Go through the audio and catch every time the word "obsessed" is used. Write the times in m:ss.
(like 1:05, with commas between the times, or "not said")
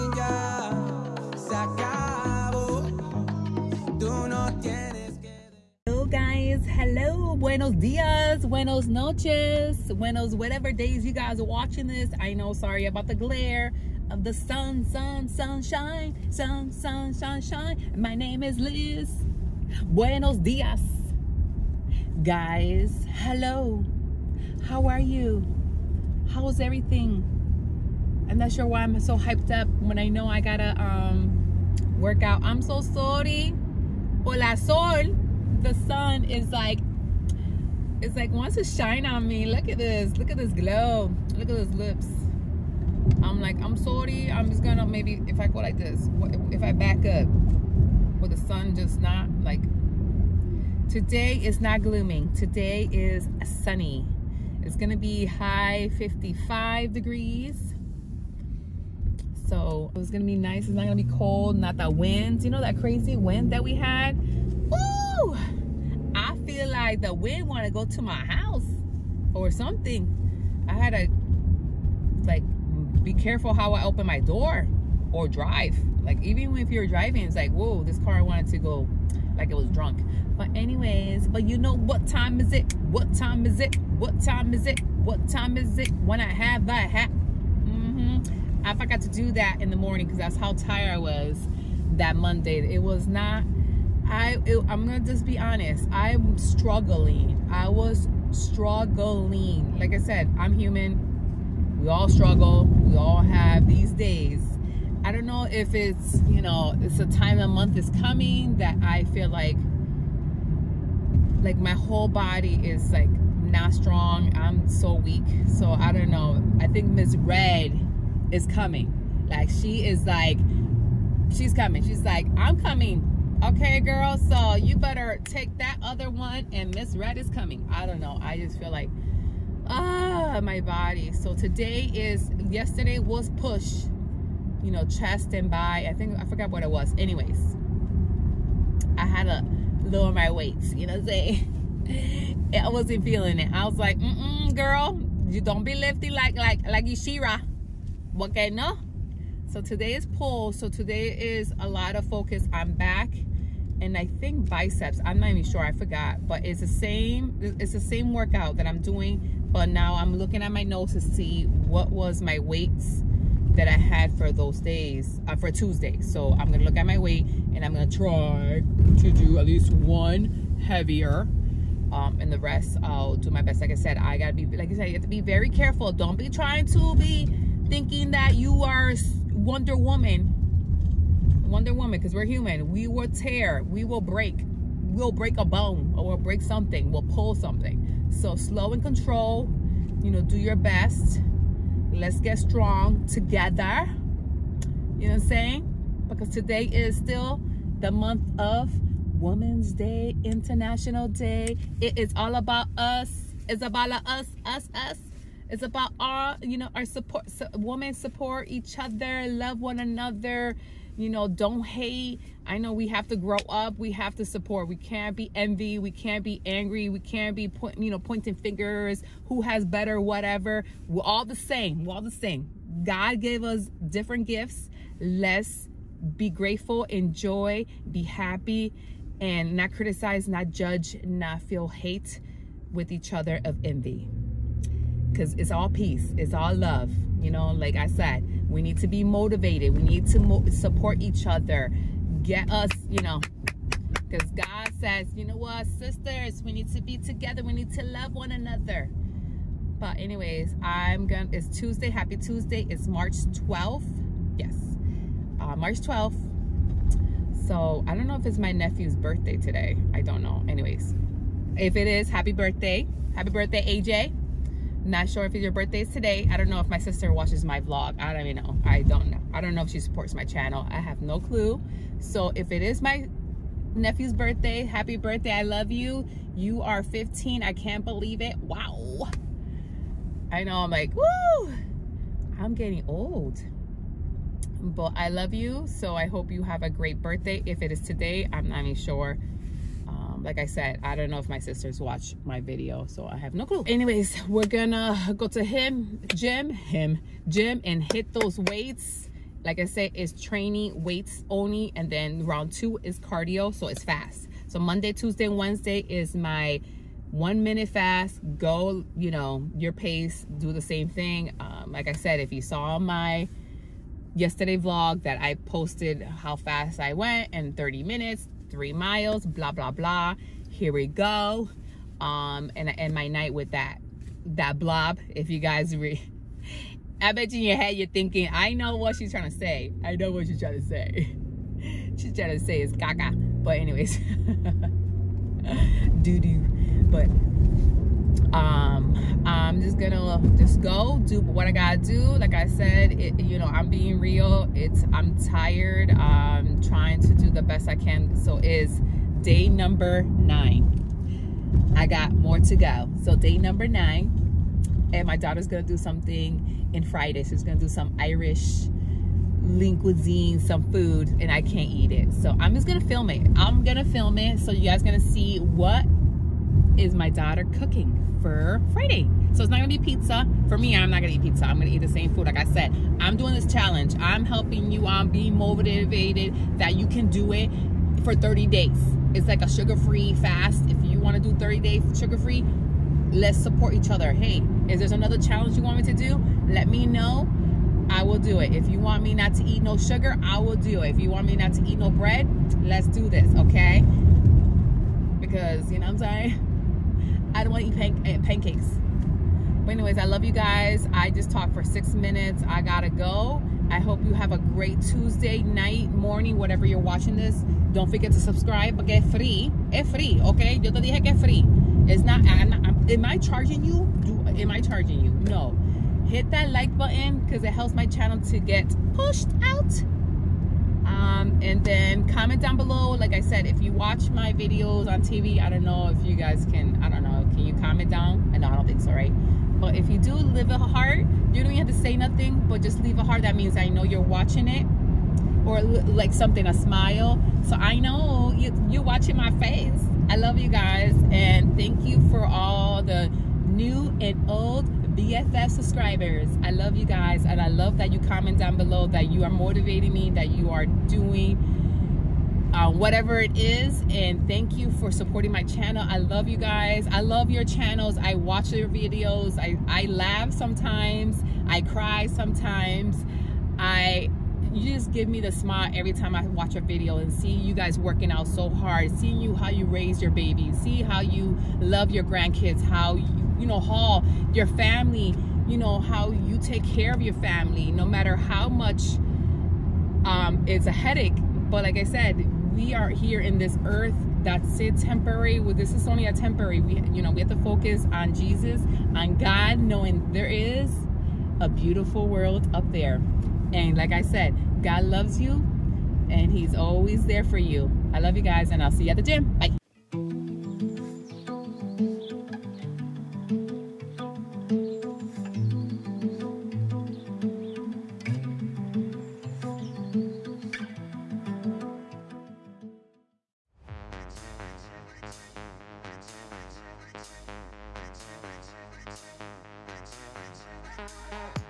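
not said.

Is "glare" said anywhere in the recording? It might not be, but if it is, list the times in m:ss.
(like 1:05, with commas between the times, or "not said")
0:13.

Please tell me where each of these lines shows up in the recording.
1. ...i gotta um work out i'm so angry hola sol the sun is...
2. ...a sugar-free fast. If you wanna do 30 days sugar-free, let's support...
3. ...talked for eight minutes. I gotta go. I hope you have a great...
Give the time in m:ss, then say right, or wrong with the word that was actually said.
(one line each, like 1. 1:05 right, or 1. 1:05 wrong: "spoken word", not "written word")
1. 0:30 wrong: "sorry", not "angry"
2. 6:19 right
3. 6:41 wrong: "six", not "eight".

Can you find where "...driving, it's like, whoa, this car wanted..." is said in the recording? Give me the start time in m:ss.
1:16.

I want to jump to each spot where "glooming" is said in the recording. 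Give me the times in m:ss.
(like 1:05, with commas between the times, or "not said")
0:51.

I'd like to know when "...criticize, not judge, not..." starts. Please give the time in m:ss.
3:49.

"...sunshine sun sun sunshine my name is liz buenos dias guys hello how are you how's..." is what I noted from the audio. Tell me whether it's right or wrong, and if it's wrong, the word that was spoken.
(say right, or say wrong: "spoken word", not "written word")
right.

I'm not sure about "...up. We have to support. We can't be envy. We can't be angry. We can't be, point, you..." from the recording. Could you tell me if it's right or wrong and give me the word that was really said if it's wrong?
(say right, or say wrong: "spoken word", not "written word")
right.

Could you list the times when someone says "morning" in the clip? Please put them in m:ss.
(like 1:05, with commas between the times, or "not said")
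1:29, 6:45.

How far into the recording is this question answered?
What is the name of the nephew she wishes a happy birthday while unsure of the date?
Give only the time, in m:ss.
4:23.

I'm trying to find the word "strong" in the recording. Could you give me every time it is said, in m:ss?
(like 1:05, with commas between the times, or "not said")
1:53, 3:12.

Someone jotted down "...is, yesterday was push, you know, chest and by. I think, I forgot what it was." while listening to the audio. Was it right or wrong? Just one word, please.
right.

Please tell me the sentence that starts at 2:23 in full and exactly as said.
I was like, mm-mm, girl, you don't be lifty like, like, like Ishira.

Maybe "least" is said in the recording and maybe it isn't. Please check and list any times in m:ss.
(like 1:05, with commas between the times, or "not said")
2:49.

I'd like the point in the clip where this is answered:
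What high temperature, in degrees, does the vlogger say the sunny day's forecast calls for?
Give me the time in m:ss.
0:55.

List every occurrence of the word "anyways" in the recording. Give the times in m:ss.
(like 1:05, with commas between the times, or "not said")
1:20, 2:16, 4:09, 4:20, 4:53, 5:33, 6:39.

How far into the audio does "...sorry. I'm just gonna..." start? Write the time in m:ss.
0:43.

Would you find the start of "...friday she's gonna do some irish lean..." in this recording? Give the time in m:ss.
5:56.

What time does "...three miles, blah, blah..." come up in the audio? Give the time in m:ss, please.
5:18.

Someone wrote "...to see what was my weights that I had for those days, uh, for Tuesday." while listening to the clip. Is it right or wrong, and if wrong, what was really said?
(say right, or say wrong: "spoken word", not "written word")
right.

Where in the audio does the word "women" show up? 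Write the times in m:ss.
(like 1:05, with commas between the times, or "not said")
3:19, 3:27.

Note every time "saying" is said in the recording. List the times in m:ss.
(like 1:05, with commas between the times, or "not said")
2:21, 3:15, 6:36.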